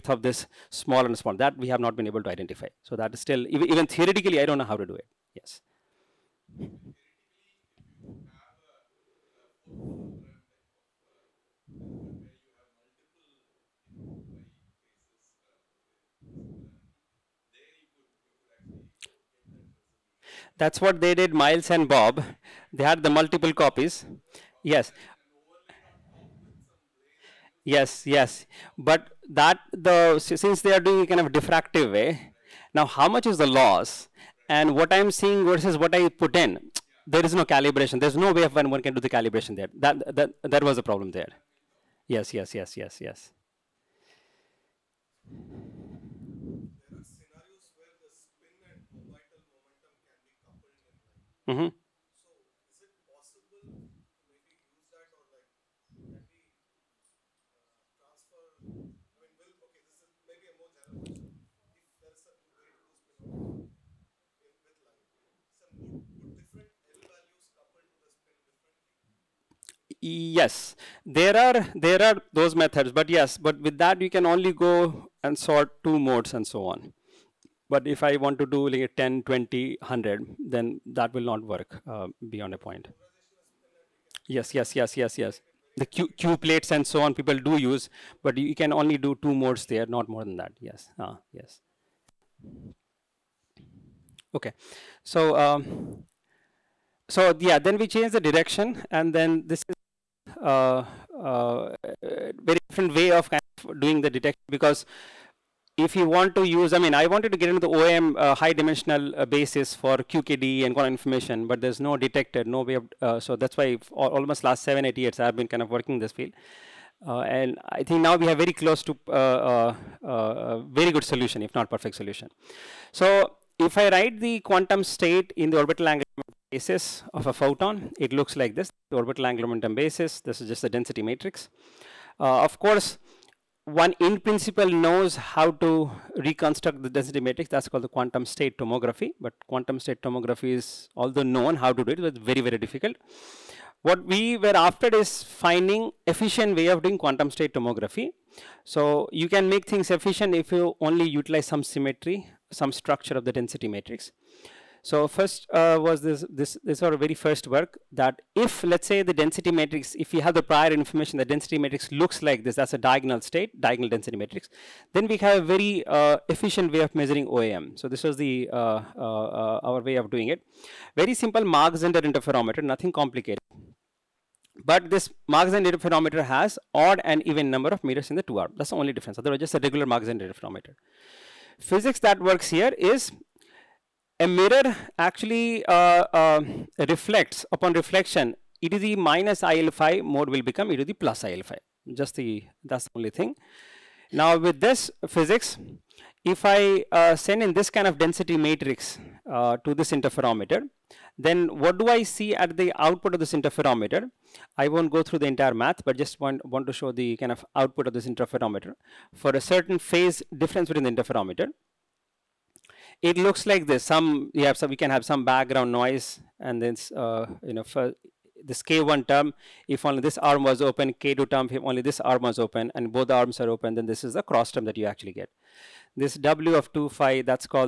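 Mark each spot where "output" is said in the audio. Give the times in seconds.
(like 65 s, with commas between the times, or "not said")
202 s, 207 s.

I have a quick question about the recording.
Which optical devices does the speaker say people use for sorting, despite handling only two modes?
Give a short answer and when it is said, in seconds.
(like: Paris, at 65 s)
Q plates, at 86 s.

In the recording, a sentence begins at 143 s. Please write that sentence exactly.
What we were after is finding efficient way of doing quantum state tomography.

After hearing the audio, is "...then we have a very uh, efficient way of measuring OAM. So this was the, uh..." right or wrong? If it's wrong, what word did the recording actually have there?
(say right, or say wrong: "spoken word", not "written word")
right.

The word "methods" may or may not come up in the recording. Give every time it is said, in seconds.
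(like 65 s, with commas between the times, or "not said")
72 s.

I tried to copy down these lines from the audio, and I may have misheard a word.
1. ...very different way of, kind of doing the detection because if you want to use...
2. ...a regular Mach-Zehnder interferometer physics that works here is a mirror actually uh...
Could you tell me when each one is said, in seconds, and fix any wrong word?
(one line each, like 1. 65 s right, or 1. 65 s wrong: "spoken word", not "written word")
1. 102 s right
2. 179 s right.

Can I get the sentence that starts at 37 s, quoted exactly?
There's no way of when one can do the calibration there.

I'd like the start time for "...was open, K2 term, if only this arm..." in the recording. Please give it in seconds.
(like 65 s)
220 s.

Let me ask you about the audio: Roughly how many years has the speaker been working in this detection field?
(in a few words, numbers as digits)
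7 or 8 years.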